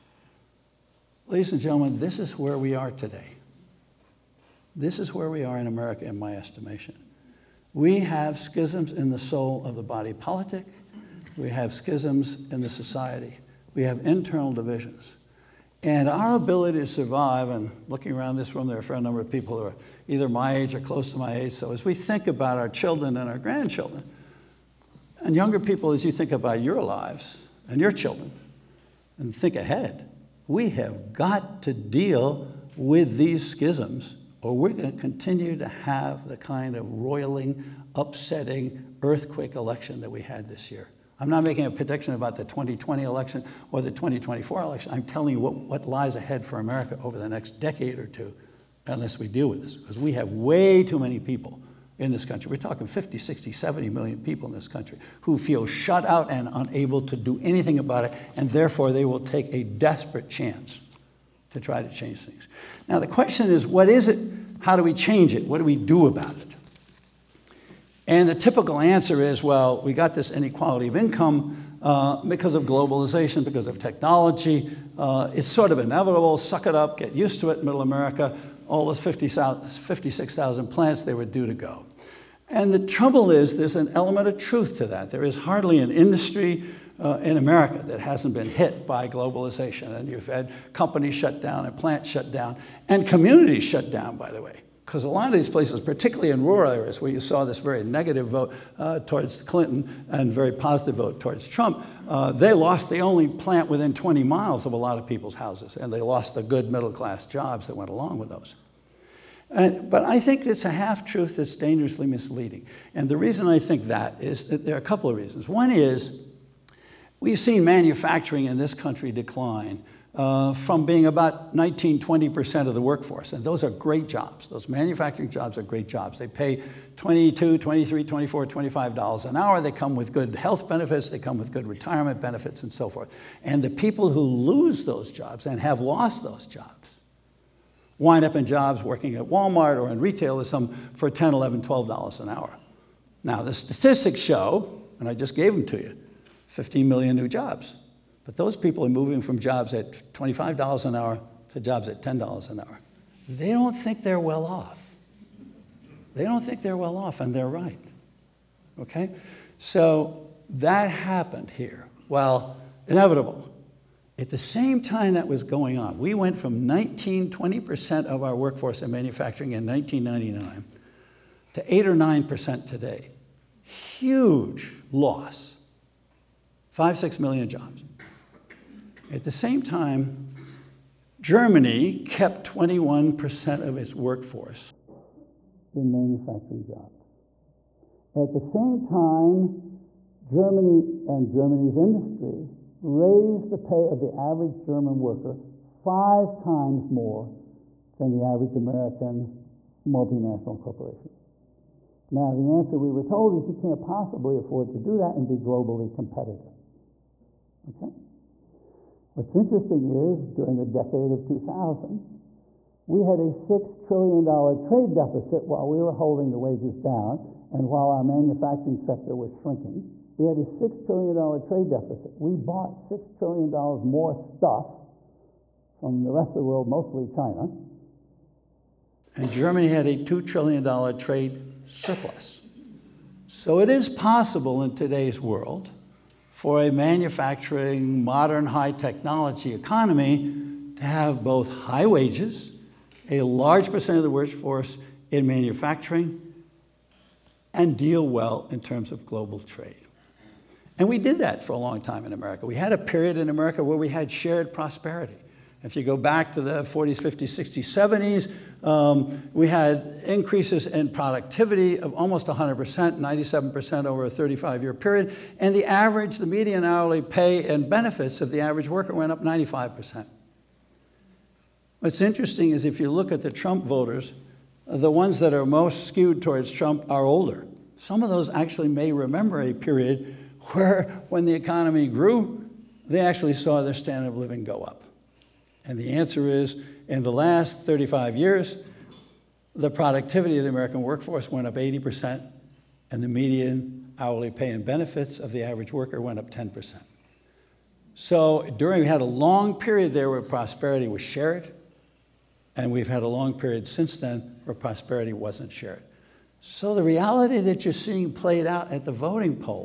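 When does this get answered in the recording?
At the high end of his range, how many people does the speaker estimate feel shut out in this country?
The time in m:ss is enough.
0:53.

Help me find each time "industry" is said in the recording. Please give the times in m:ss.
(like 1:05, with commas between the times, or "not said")
1:25, 3:11.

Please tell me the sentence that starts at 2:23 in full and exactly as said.
Now the statistics show, and I just gave them to you, 15 million new jobs.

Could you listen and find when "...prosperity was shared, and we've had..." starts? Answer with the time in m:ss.
5:00.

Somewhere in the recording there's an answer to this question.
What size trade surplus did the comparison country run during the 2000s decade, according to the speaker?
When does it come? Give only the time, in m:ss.
3:49.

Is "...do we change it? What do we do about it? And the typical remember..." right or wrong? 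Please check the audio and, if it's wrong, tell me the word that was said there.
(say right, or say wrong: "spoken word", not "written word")
wrong: "answer", not "remember".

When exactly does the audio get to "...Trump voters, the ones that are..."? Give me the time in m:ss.
4:33.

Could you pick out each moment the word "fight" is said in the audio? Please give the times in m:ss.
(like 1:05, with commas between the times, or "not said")
not said.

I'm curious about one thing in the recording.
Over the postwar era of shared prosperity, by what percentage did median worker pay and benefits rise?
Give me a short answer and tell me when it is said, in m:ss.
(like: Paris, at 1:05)
95%, at 4:29.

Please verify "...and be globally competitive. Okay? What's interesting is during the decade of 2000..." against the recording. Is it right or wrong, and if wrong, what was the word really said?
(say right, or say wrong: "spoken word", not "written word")
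right.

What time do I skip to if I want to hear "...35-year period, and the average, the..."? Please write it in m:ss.
4:24.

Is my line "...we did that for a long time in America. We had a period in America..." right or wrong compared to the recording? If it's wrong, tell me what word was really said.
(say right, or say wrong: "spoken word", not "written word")
right.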